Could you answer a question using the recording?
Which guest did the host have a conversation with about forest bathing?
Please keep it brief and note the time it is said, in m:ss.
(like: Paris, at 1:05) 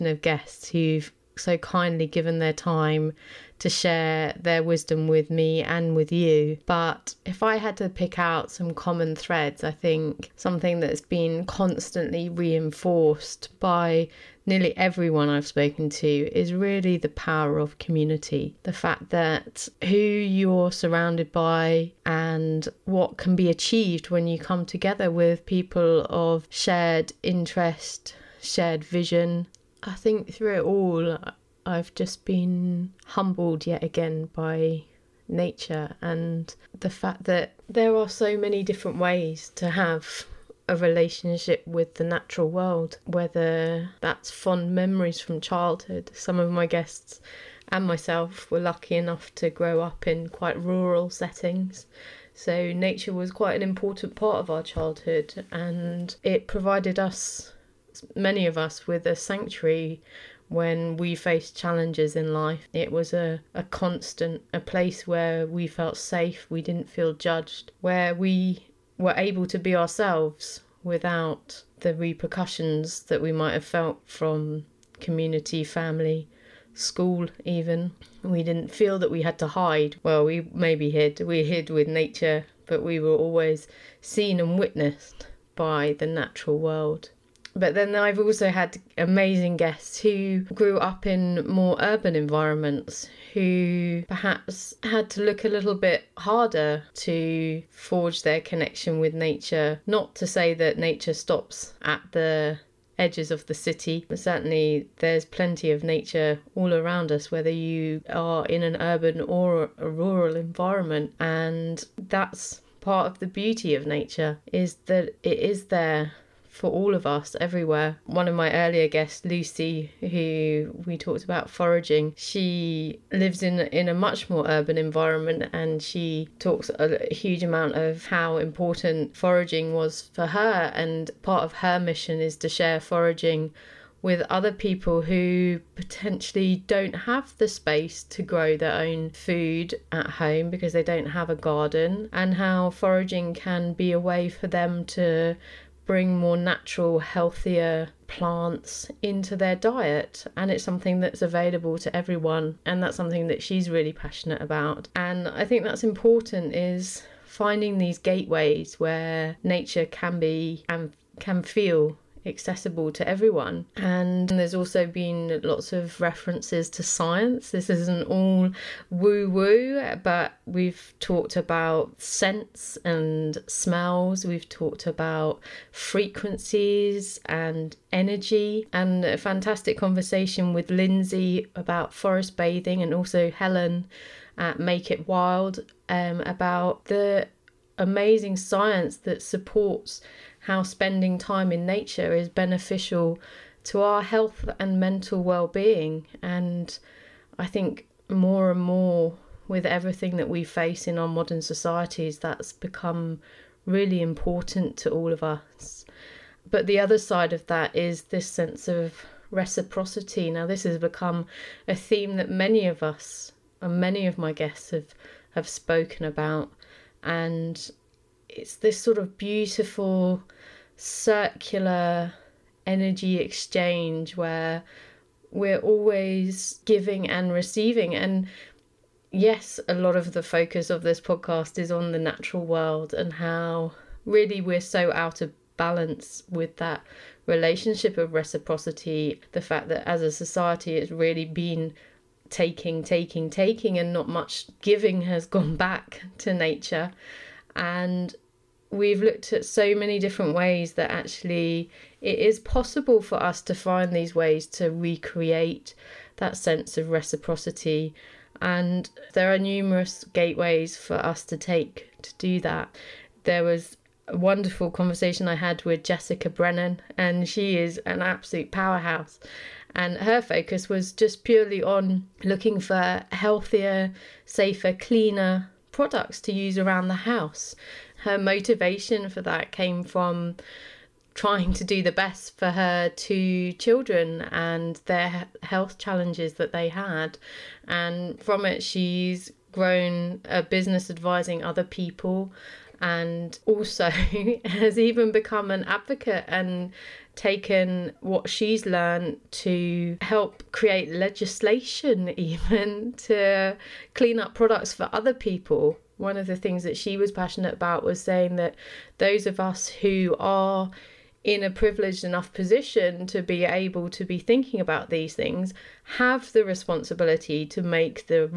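Lindsay, at 3:00.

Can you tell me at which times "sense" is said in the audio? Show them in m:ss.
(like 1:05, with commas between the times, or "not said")
3:28, 4:16.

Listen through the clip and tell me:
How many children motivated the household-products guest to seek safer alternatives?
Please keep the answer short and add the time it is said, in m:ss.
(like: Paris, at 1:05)
2, at 4:42.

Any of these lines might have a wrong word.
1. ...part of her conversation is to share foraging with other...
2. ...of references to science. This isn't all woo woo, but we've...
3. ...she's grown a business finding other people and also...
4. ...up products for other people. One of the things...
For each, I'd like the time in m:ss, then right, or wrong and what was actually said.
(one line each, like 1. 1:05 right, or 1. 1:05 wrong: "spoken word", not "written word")
1. 2:11 wrong: "mission", not "conversation"
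2. 2:45 right
3. 4:48 wrong: "advising", not "finding"
4. 5:04 right.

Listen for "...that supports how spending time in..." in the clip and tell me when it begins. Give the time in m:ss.
3:08.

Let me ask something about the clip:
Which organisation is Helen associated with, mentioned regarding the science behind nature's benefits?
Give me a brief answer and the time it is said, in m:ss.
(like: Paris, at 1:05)
Make It Wild, at 3:04.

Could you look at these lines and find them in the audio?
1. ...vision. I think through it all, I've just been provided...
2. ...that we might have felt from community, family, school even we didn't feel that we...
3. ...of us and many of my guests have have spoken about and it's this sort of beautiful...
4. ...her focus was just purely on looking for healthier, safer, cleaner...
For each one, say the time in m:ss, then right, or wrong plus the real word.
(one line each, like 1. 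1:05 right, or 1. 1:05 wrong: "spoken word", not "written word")
1. 0:28 wrong: "humbled", not "provided"
2. 1:13 right
3. 3:32 right
4. 4:29 right.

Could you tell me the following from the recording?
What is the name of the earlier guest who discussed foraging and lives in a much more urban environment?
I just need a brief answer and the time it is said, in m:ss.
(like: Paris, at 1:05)
Lucy, at 1:59.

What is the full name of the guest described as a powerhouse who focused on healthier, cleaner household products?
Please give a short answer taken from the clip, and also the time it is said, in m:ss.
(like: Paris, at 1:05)
Jessica Brennan, at 4:25.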